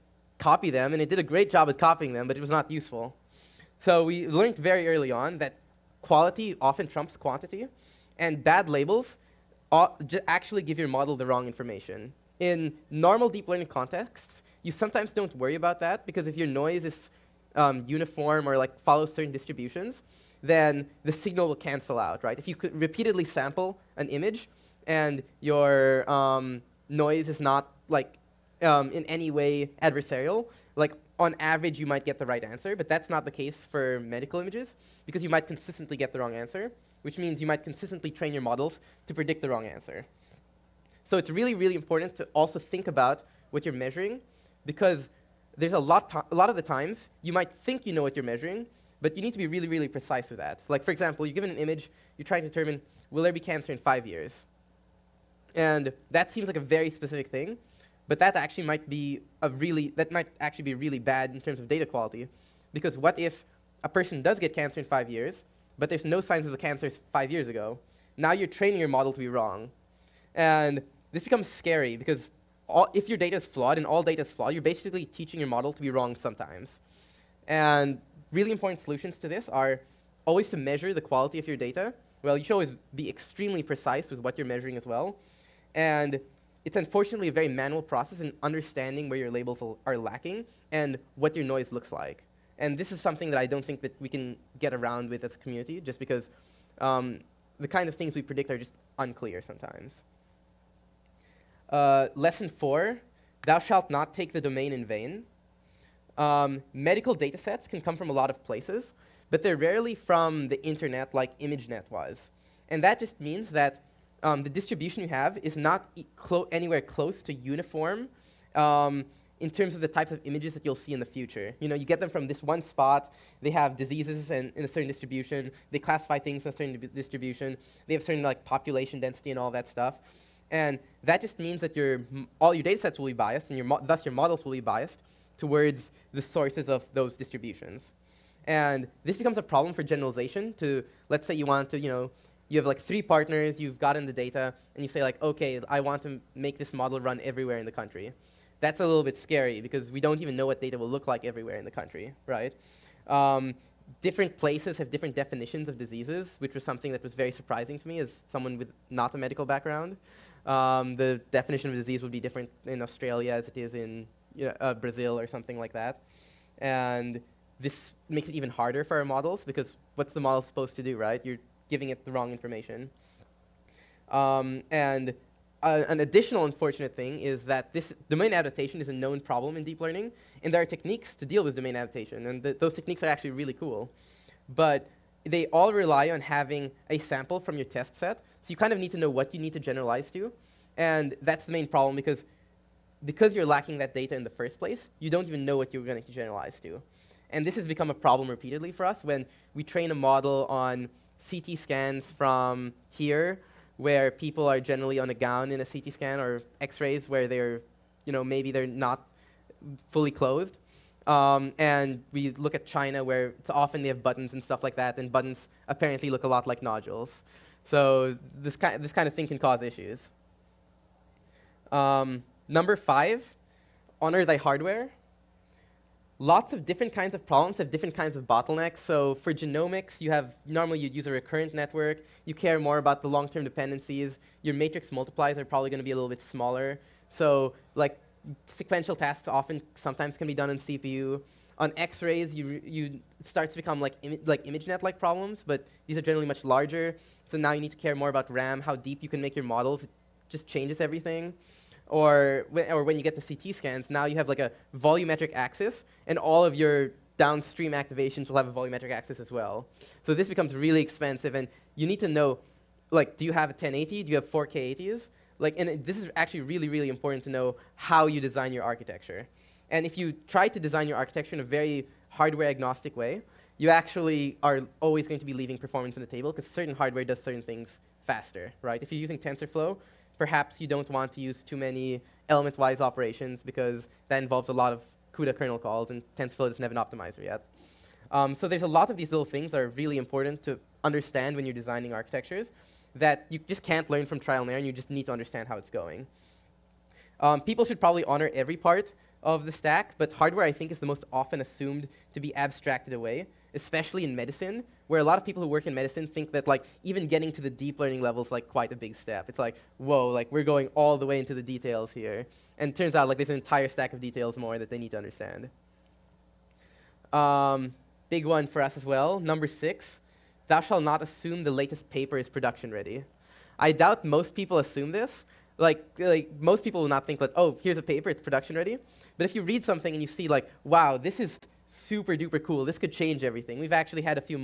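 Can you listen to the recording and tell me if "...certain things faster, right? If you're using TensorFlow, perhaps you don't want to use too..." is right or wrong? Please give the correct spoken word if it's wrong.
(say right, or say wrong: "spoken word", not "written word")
right.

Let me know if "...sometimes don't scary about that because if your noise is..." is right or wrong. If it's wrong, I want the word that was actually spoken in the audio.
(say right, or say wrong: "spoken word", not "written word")
wrong: "worry", not "scary".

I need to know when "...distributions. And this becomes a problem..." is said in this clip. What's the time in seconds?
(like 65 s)
137 s.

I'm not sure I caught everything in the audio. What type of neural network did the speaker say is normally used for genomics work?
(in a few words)
Recurrent network.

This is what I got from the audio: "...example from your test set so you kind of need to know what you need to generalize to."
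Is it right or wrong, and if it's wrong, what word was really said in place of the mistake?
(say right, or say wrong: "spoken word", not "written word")
wrong: "sample", not "example".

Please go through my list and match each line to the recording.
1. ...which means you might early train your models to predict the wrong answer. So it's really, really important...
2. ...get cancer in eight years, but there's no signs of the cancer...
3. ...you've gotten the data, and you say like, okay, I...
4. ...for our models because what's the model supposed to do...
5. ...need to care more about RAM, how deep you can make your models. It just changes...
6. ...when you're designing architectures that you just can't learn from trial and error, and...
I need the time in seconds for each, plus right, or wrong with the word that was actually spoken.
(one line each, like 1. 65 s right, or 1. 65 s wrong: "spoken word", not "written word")
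1. 37 s wrong: "consistently", not "early"
2. 64 s wrong: "five", not "eight"
3. 143 s right
4. 168 s right
5. 247 s right
6. 291 s right.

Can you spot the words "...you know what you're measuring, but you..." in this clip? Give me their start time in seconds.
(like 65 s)
47 s.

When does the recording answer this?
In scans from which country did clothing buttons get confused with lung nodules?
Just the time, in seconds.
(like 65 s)
212 s.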